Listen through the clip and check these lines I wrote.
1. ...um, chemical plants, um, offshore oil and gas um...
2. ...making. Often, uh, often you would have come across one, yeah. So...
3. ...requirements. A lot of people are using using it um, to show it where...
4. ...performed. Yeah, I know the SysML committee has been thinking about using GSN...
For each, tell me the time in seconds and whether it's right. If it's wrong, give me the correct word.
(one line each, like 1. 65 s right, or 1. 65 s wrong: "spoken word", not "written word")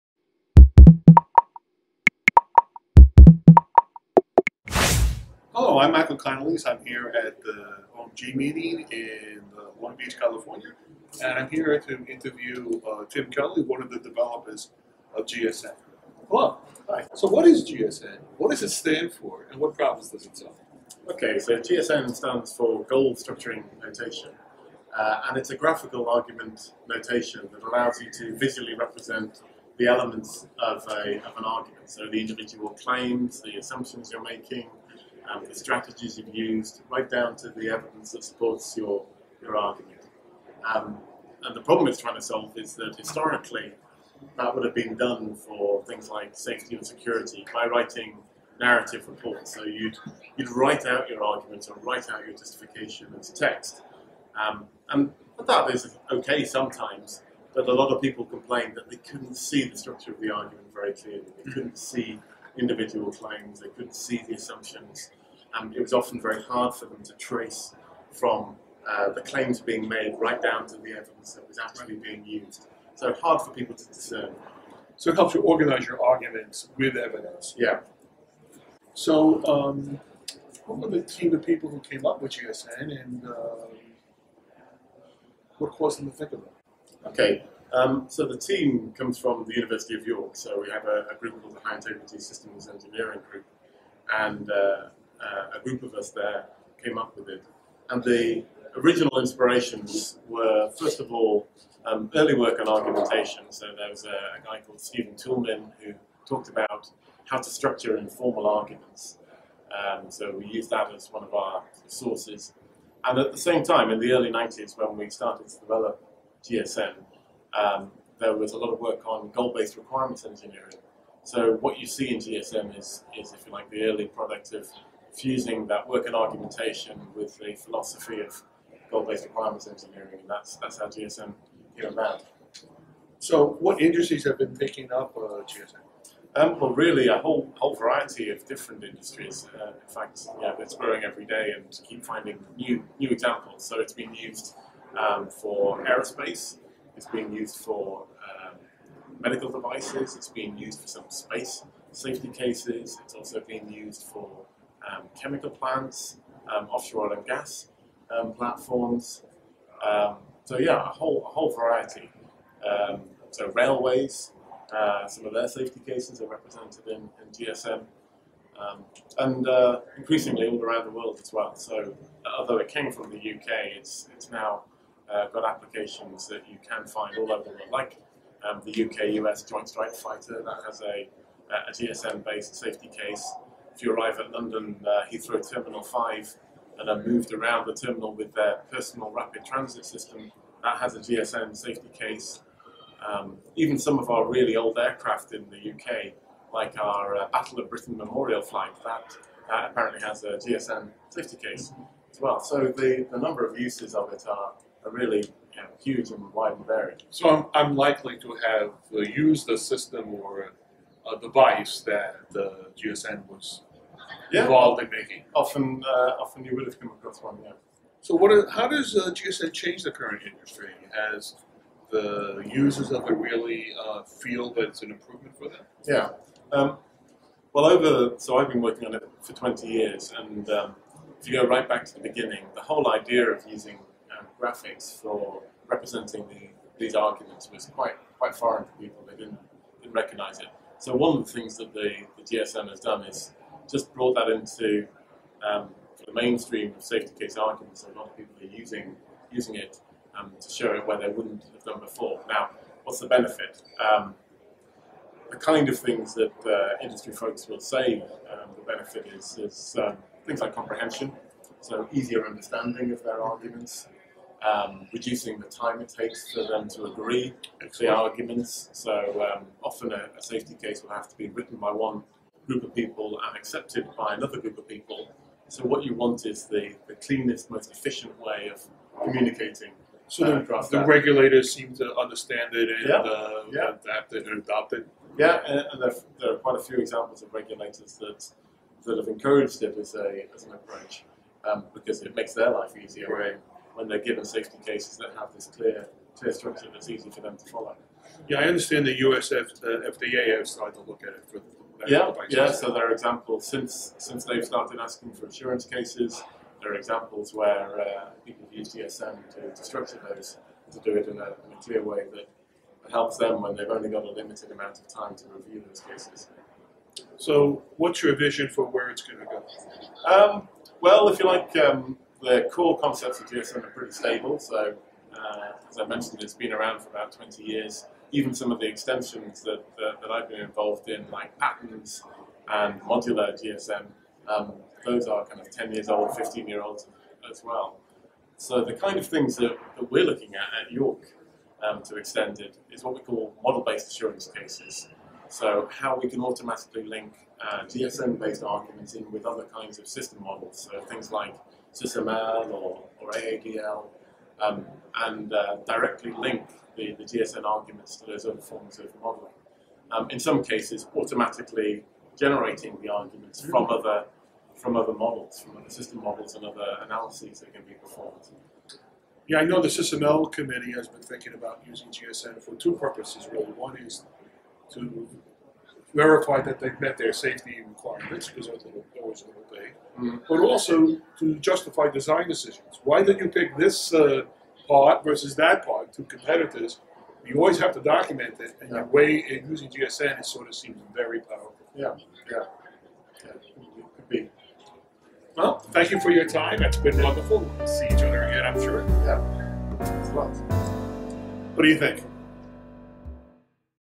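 1. 154 s right
2. 214 s right
3. 247 s wrong: "arguments", not "requirements"
4. 367 s right.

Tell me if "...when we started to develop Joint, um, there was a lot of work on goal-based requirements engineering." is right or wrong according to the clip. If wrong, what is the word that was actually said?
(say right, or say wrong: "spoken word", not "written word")
wrong: "GSN", not "Joint".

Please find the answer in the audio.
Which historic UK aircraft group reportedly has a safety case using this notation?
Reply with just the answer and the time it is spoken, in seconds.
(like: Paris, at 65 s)
Battle of Britain Memorial flight, at 197 s.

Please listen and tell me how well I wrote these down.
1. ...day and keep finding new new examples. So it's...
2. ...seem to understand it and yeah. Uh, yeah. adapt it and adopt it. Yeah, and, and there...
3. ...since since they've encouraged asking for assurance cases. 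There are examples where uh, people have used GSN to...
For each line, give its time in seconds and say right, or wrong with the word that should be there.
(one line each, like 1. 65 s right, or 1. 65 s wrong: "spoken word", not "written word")
1. 141 s right
2. 281 s right
3. 303 s wrong: "started", not "encouraged".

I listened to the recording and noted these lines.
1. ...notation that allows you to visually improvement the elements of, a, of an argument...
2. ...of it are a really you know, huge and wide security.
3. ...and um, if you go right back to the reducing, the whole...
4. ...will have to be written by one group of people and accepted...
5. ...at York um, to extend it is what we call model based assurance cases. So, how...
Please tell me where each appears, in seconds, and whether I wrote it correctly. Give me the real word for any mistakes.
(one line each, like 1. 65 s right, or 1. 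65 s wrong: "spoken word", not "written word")
1. 26 s wrong: "represent", not "improvement"
2. 203 s wrong: "variety", not "security"
3. 230 s wrong: "beginning", not "reducing"
4. 270 s right
5. 340 s right.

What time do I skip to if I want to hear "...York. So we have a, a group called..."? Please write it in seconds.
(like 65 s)
90 s.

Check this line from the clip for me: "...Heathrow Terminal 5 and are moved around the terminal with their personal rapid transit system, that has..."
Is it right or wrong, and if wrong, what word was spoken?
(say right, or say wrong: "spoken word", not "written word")
right.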